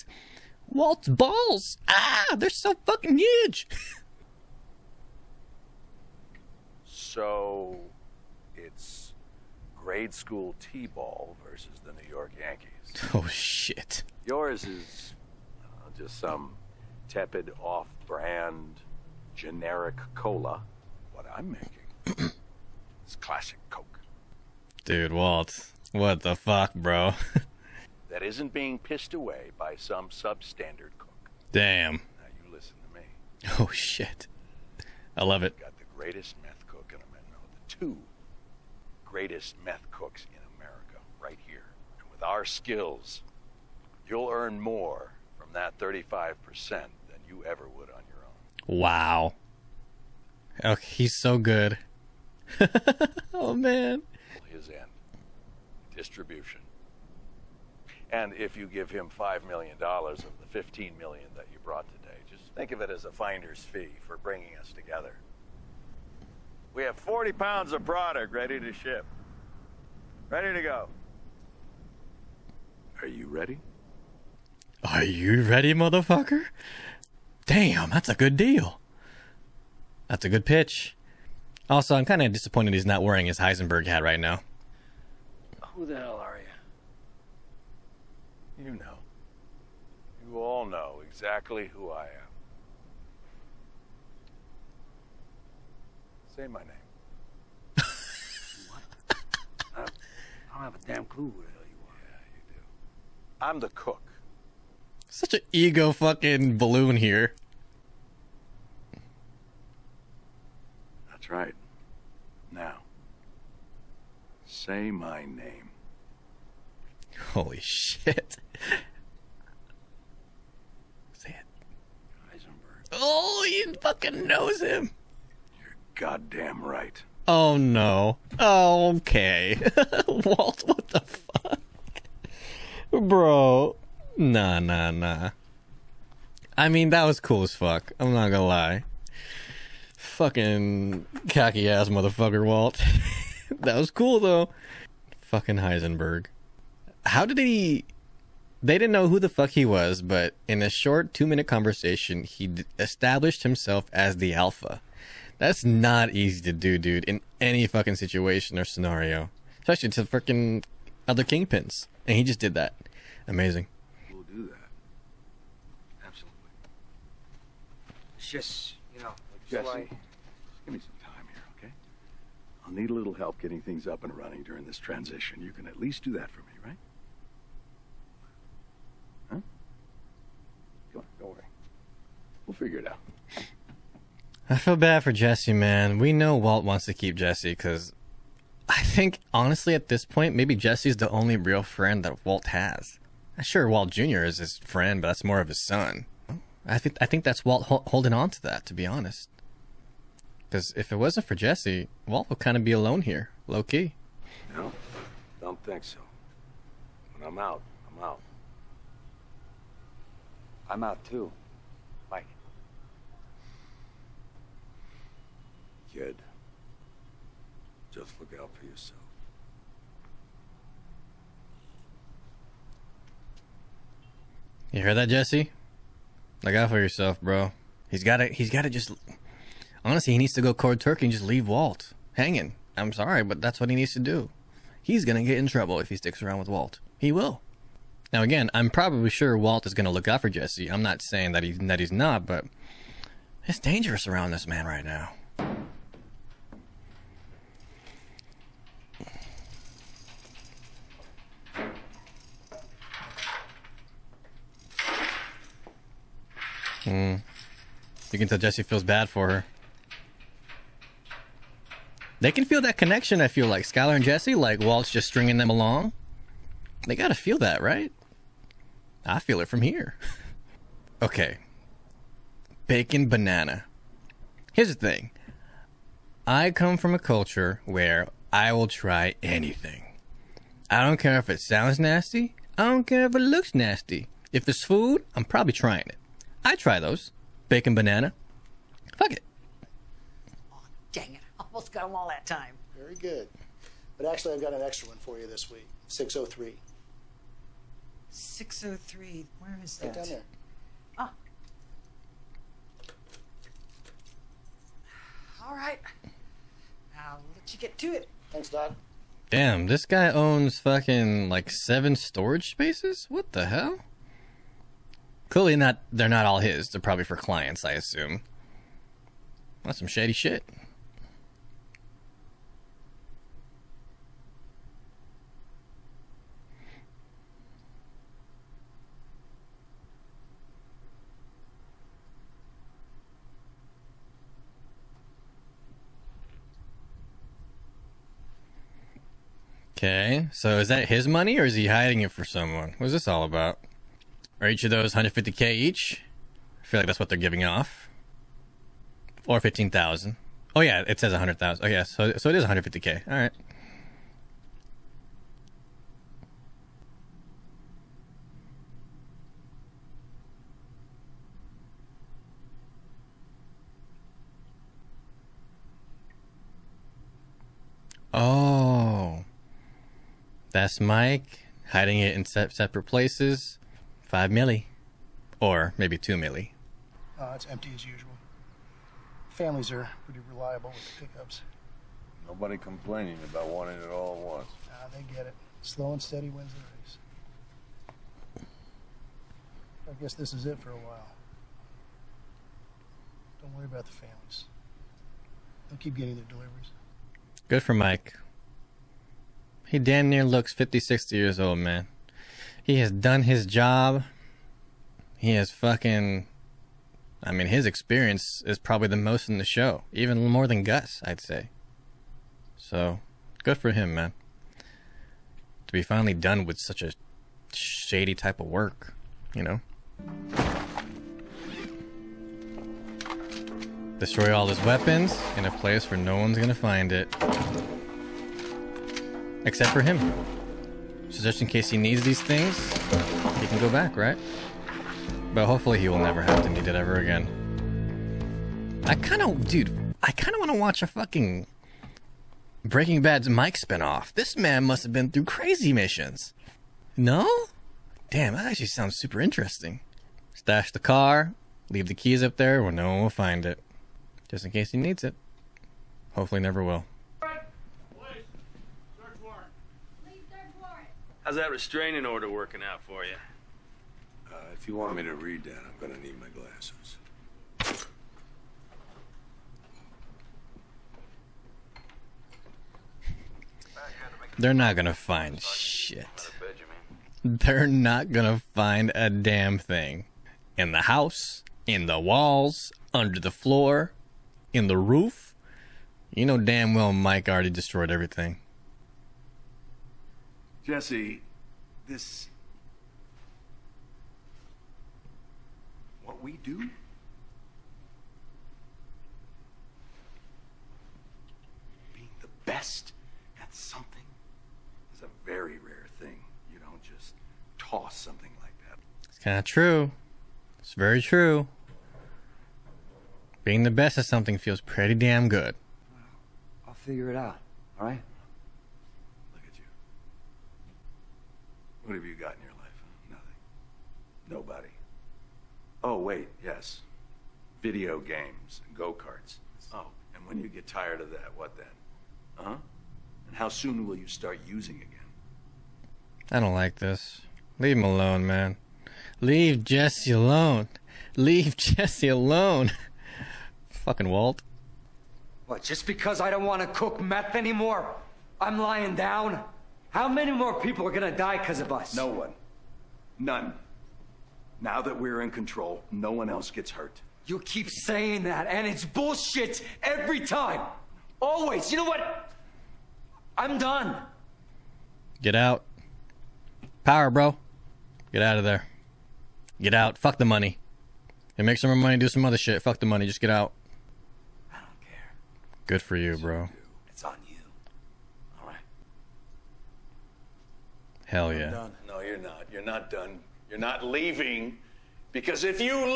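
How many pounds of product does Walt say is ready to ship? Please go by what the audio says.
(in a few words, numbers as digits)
40 pounds.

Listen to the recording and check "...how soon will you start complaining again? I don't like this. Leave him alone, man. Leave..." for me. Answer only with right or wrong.
wrong.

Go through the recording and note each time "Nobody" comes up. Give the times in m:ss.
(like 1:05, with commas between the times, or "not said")
6:22, 8:44.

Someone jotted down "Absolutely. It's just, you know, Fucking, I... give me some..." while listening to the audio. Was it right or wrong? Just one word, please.
wrong.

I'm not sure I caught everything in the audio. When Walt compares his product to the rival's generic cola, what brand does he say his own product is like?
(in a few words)
Classic Coke.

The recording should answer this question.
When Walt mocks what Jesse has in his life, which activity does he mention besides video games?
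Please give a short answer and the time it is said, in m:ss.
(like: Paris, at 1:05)
Go karts, at 8:48.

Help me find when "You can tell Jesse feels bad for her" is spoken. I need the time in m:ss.
4:18.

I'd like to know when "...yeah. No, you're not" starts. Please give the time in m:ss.
9:41.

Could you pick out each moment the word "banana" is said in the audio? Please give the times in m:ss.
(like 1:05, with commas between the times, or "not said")
4:33, 4:47.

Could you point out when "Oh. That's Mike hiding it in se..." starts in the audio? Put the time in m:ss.
6:08.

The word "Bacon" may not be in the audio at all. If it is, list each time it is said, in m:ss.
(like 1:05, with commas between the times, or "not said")
4:32, 4:47.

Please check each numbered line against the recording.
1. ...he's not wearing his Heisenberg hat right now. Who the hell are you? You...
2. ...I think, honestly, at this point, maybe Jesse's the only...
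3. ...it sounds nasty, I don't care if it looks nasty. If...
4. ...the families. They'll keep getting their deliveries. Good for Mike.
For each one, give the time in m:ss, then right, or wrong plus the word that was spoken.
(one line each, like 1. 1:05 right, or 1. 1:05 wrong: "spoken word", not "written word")
1. 1:22 right
2. 3:08 right
3. 4:41 right
4. 6:33 right.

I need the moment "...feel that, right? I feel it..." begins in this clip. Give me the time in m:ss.
4:27.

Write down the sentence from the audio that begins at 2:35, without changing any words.
That's not easy to do, dude, in any fucking situation or scenario.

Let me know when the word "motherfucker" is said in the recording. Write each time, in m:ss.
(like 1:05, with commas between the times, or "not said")
1:15, 2:21.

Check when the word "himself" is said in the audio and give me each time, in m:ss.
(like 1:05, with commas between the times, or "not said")
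2:33.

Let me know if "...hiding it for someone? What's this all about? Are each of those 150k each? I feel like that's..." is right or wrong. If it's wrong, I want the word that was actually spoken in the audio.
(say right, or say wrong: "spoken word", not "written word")
right.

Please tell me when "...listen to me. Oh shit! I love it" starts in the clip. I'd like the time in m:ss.
0:32.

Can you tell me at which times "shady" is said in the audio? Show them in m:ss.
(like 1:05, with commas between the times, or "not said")
5:19, 6:57.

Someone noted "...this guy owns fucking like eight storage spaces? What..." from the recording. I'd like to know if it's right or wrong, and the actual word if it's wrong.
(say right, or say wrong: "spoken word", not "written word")
wrong: "seven", not "eight".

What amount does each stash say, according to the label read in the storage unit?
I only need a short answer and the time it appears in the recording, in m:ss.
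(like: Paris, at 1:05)
100,000, at 5:51.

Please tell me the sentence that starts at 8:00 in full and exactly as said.
In the house, in the walls, under the floor, in the roof.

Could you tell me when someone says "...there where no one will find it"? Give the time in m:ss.
7:32.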